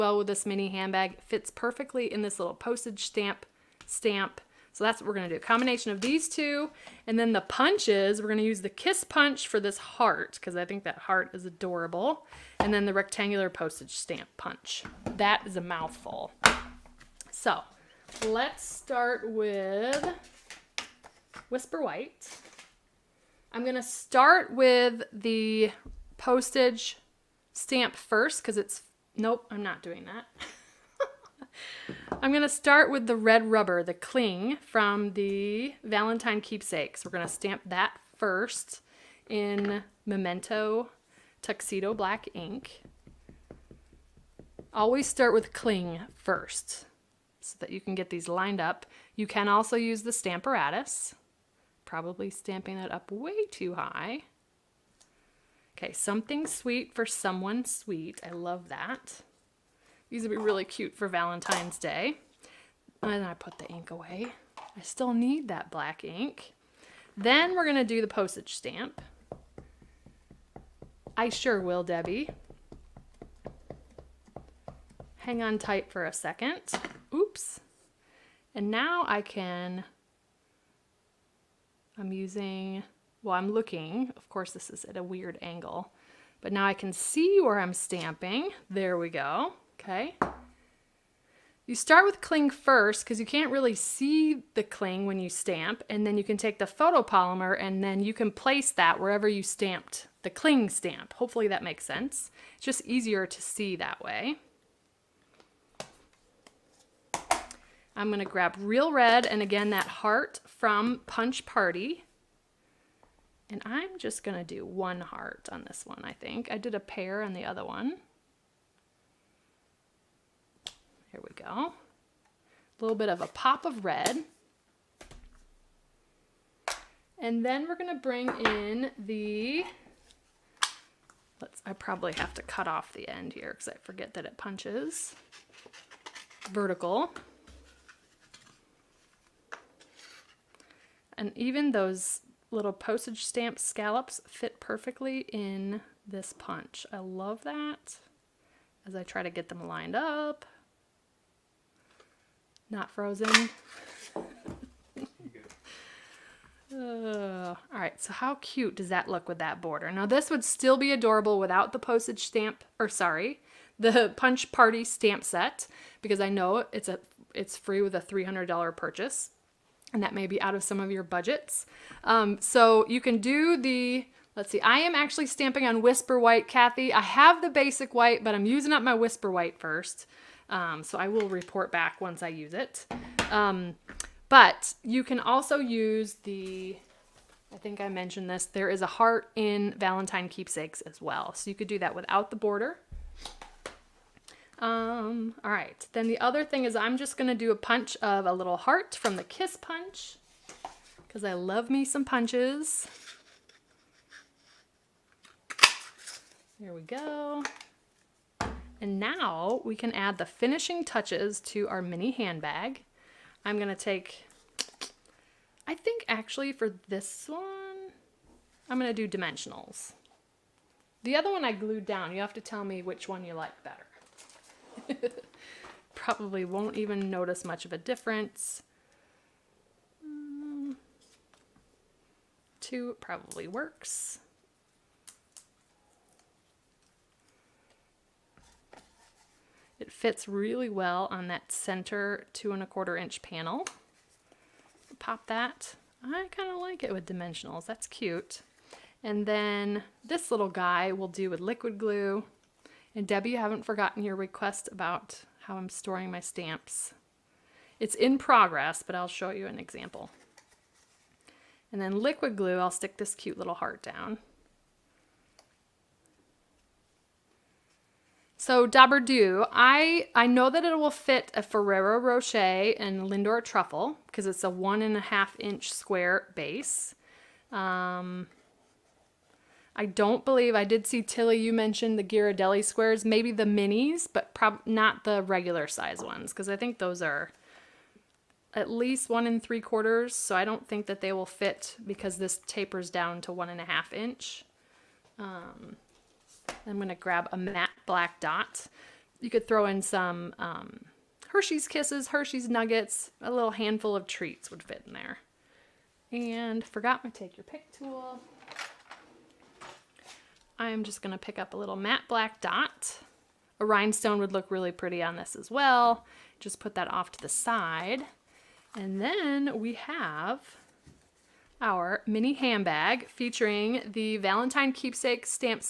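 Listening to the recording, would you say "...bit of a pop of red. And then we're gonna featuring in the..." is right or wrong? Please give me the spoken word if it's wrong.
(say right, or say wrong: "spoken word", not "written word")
wrong: "bring", not "featuring".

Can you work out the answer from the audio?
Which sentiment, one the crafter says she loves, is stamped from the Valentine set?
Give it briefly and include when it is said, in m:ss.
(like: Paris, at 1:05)
Something sweet for someone sweet, at 0:55.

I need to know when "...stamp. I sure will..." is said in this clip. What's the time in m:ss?
1:08.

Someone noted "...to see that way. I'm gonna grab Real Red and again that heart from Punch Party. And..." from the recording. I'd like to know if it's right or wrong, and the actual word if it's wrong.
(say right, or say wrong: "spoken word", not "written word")
right.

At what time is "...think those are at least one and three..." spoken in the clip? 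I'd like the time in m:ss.
4:46.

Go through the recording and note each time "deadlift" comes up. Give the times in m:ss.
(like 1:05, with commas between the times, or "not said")
not said.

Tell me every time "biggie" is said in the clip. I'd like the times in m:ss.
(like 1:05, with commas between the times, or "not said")
not said.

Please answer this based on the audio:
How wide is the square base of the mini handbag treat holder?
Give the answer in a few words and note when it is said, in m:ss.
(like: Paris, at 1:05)
1.5 inches, at 4:34.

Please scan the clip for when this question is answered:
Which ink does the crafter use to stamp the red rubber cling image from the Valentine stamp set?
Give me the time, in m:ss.
0:40.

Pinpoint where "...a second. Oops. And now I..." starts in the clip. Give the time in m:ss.
1:16.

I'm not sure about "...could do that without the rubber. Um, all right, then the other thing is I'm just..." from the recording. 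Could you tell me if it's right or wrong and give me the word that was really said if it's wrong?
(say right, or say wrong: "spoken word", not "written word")
wrong: "border", not "rubber".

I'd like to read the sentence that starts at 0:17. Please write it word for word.
So let's start with Whisper White.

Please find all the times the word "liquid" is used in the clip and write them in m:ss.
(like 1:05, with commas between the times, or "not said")
4:11, 4:21.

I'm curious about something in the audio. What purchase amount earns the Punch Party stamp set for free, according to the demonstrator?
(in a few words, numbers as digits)
$300.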